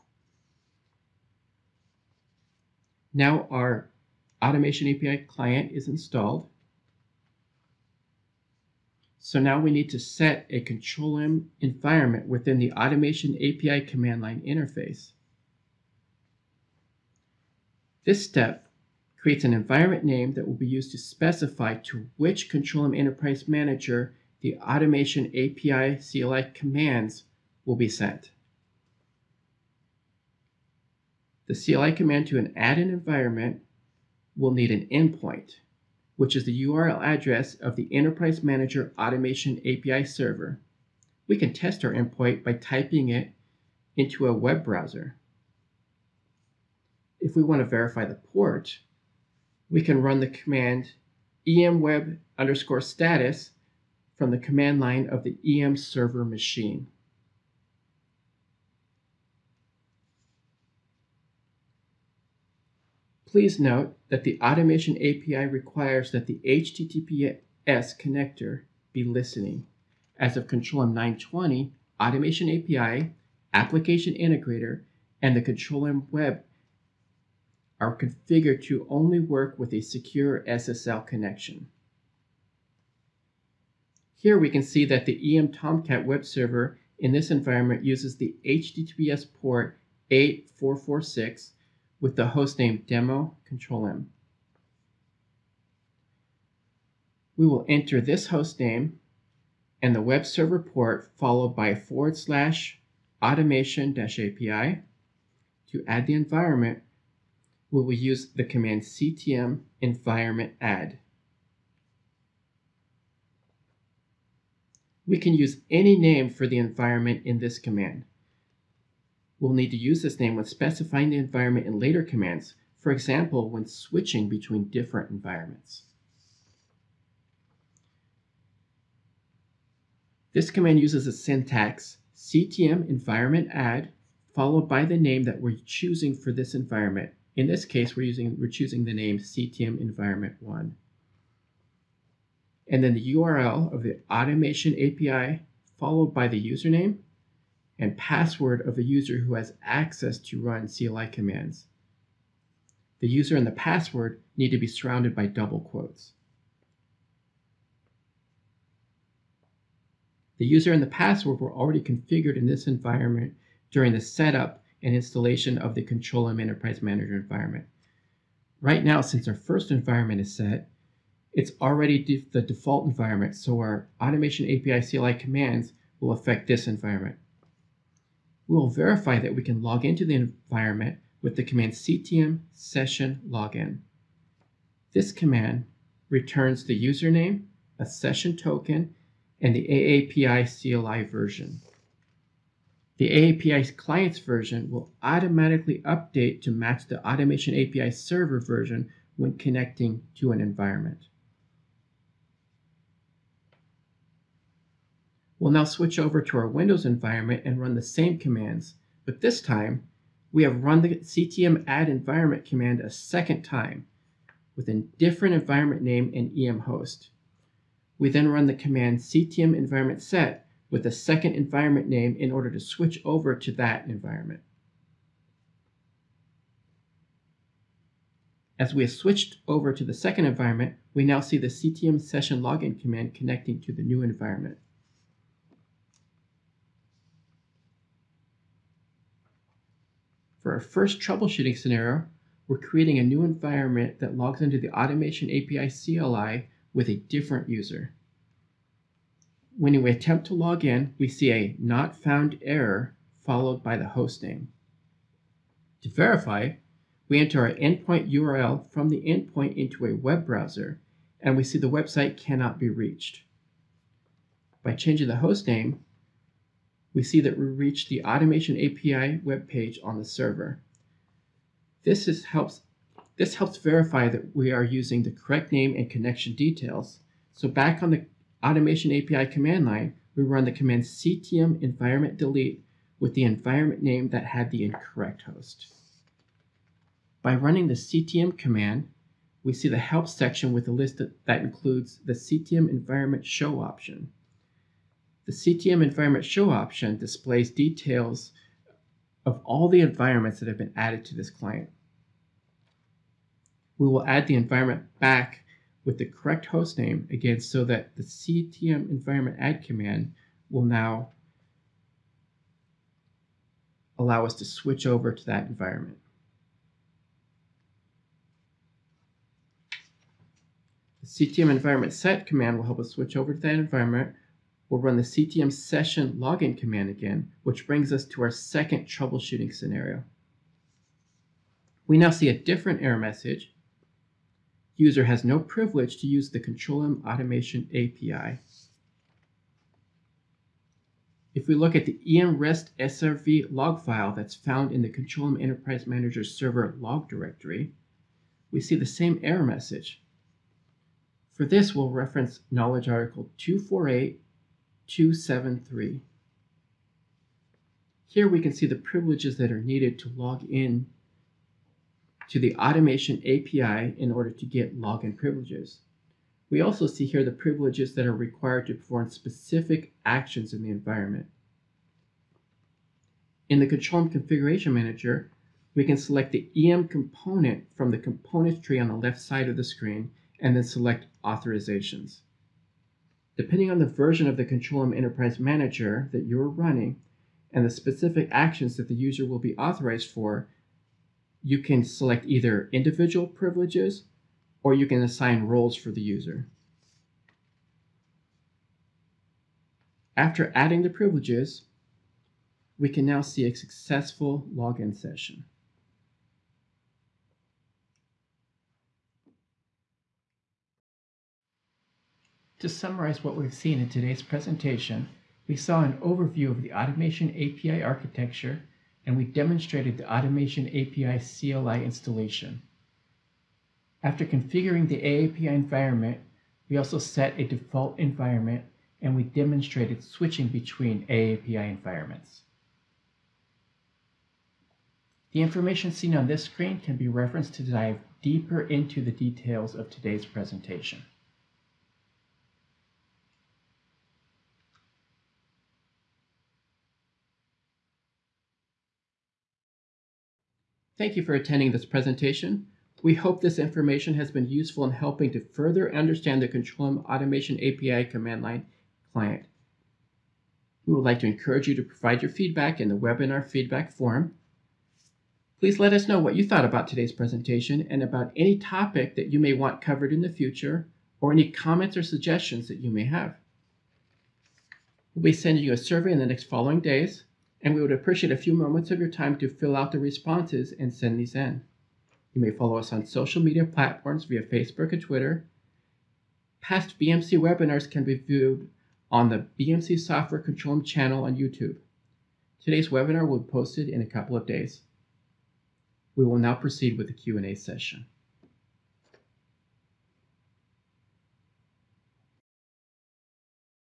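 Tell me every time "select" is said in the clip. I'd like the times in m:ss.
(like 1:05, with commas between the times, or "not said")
6:15, 6:20, 6:31.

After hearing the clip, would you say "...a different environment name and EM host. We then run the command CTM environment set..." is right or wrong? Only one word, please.
right.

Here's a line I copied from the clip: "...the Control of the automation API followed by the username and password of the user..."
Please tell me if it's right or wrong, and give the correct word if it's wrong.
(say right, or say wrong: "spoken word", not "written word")
wrong: "URL", not "Control".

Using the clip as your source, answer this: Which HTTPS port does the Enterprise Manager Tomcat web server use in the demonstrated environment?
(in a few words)
8446.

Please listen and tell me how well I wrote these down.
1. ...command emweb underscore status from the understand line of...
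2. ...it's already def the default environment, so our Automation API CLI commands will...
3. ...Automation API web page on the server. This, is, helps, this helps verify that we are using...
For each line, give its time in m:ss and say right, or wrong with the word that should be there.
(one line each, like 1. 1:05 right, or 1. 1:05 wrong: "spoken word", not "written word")
1. 0:50 wrong: "command", not "understand"
2. 2:51 right
3. 4:28 right.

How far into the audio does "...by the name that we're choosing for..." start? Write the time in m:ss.
2:14.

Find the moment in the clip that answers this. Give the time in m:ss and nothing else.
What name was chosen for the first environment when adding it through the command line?
2:19.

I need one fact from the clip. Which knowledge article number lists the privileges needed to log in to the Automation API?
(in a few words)
248273.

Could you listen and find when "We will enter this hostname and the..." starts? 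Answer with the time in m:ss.
1:37.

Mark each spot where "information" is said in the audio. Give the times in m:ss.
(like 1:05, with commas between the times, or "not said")
7:15, 7:33.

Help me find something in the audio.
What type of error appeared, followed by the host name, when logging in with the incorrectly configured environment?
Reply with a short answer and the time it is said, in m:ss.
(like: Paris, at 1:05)
not found, at 4:11.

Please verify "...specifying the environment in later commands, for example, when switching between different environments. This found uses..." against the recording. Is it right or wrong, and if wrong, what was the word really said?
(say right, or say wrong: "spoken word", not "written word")
wrong: "command", not "found".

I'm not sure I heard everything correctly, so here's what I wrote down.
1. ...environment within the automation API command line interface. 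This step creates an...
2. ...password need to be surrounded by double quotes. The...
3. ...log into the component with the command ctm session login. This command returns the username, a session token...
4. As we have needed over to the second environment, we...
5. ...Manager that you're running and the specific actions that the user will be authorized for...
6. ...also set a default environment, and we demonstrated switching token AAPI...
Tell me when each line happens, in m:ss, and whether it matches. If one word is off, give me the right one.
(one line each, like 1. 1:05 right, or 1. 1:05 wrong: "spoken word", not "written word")
1. 0:11 right
2. 2:33 right
3. 2:59 wrong: "environment", not "component"
4. 3:48 wrong: "switched", not "needed"
5. 6:25 right
6. 7:06 wrong: "between", not "token".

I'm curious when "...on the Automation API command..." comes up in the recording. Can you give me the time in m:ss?
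4:37.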